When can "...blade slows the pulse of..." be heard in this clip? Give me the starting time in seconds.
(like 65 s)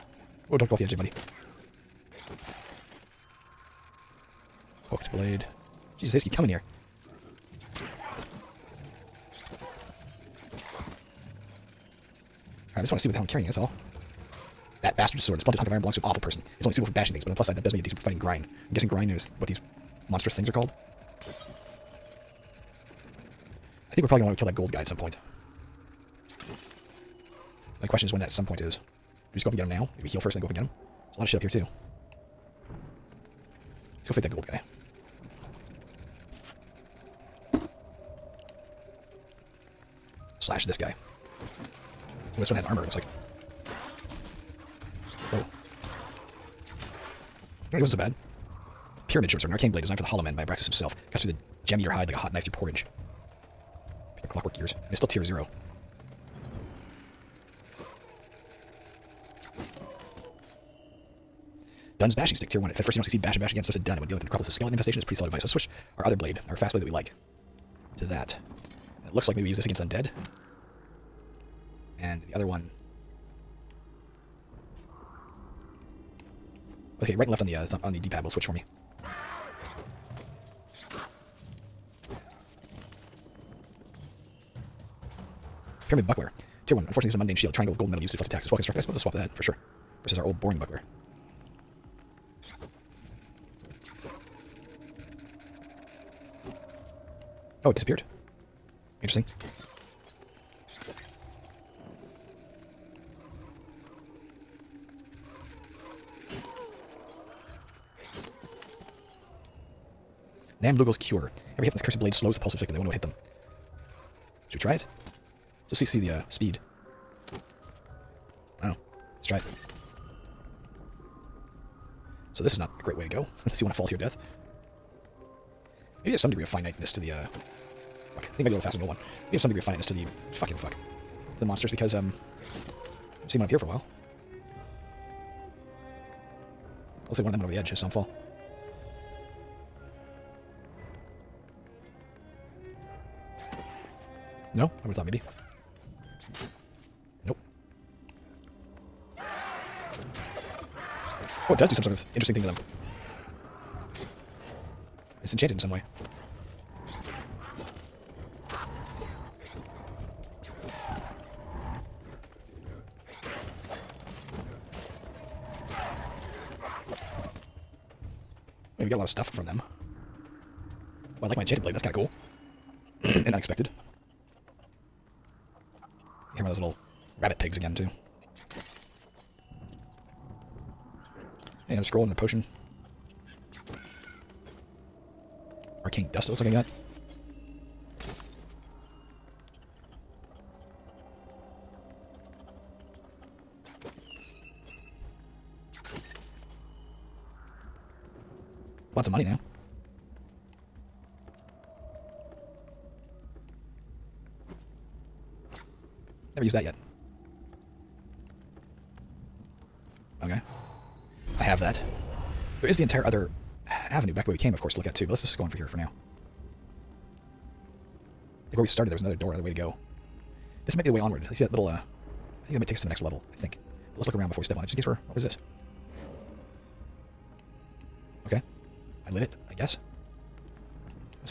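111 s.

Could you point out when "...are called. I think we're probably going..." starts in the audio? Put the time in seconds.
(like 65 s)
20 s.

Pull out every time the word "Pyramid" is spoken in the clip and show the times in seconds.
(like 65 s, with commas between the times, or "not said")
49 s, 85 s.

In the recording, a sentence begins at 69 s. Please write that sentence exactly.
And it looks like maybe we use this against undead.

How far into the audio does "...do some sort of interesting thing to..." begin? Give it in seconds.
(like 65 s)
151 s.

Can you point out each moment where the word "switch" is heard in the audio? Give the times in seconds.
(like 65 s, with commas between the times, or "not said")
65 s, 78 s.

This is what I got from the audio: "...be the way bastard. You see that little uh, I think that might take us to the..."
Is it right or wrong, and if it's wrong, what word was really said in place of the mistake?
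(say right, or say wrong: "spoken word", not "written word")
wrong: "onward", not "bastard".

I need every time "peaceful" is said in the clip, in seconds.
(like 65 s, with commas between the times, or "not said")
not said.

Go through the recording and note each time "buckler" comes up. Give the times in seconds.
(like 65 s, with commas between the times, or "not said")
86 s, 90 s.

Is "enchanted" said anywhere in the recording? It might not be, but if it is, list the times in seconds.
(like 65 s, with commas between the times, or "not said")
155 s, 171 s.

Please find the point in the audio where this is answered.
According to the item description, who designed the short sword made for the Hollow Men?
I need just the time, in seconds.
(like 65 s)
50 s.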